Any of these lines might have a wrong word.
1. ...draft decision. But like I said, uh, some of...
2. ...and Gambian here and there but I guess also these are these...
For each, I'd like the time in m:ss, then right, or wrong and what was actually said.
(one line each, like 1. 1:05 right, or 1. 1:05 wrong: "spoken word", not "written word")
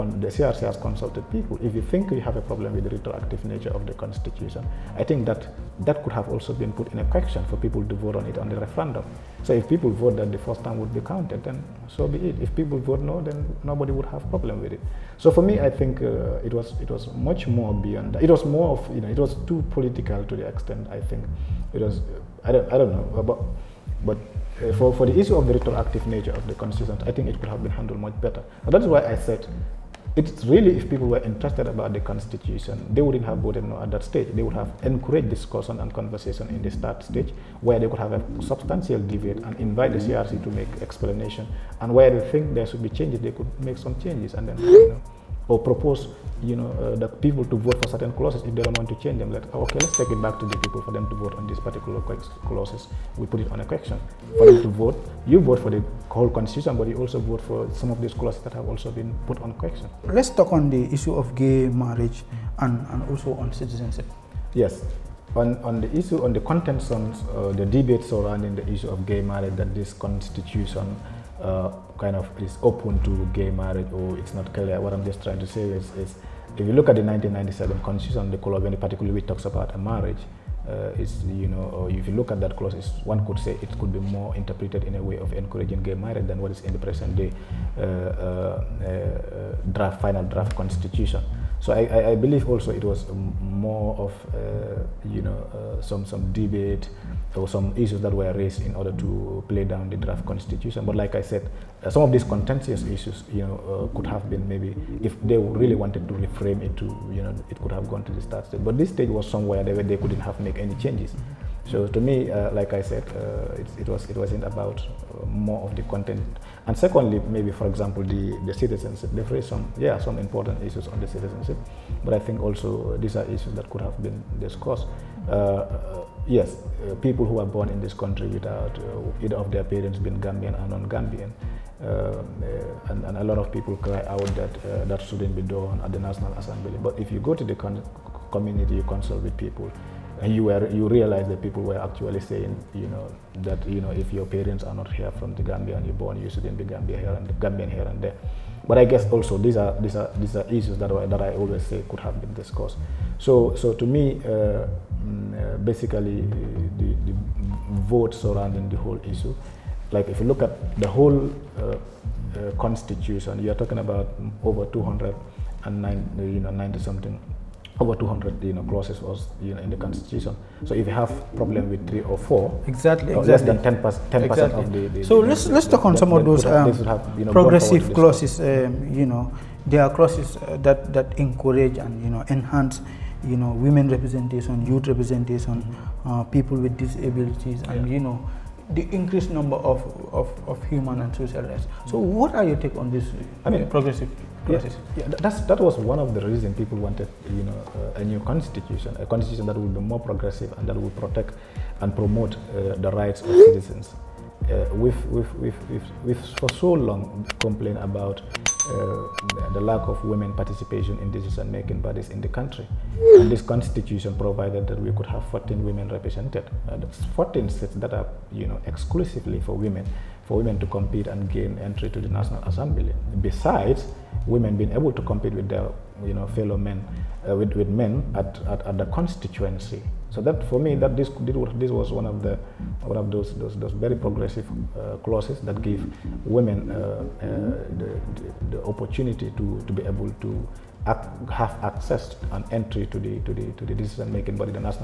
1. 1:39 wrong: "constitution", not "decision"
2. 2:27 right.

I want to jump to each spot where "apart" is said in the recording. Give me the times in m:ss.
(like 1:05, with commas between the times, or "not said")
not said.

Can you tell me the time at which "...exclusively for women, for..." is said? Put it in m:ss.
3:38.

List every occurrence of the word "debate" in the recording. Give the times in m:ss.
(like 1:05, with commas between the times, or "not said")
0:38, 1:07, 1:36.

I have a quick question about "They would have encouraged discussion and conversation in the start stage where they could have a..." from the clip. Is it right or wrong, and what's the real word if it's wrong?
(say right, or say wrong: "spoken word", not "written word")
right.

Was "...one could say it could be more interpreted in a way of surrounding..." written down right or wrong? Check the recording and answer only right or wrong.
wrong.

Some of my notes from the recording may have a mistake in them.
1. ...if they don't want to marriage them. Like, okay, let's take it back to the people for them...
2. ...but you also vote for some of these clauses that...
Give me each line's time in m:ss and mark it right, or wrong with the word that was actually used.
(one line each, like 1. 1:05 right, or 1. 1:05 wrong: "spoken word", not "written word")
1. 0:48 wrong: "change", not "marriage"
2. 0:56 right.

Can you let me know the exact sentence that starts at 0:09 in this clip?
So if people vote that the first time would be counted, then so be it.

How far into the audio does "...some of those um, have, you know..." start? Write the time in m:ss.
2:55.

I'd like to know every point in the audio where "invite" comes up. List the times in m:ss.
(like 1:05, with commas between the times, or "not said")
0:39.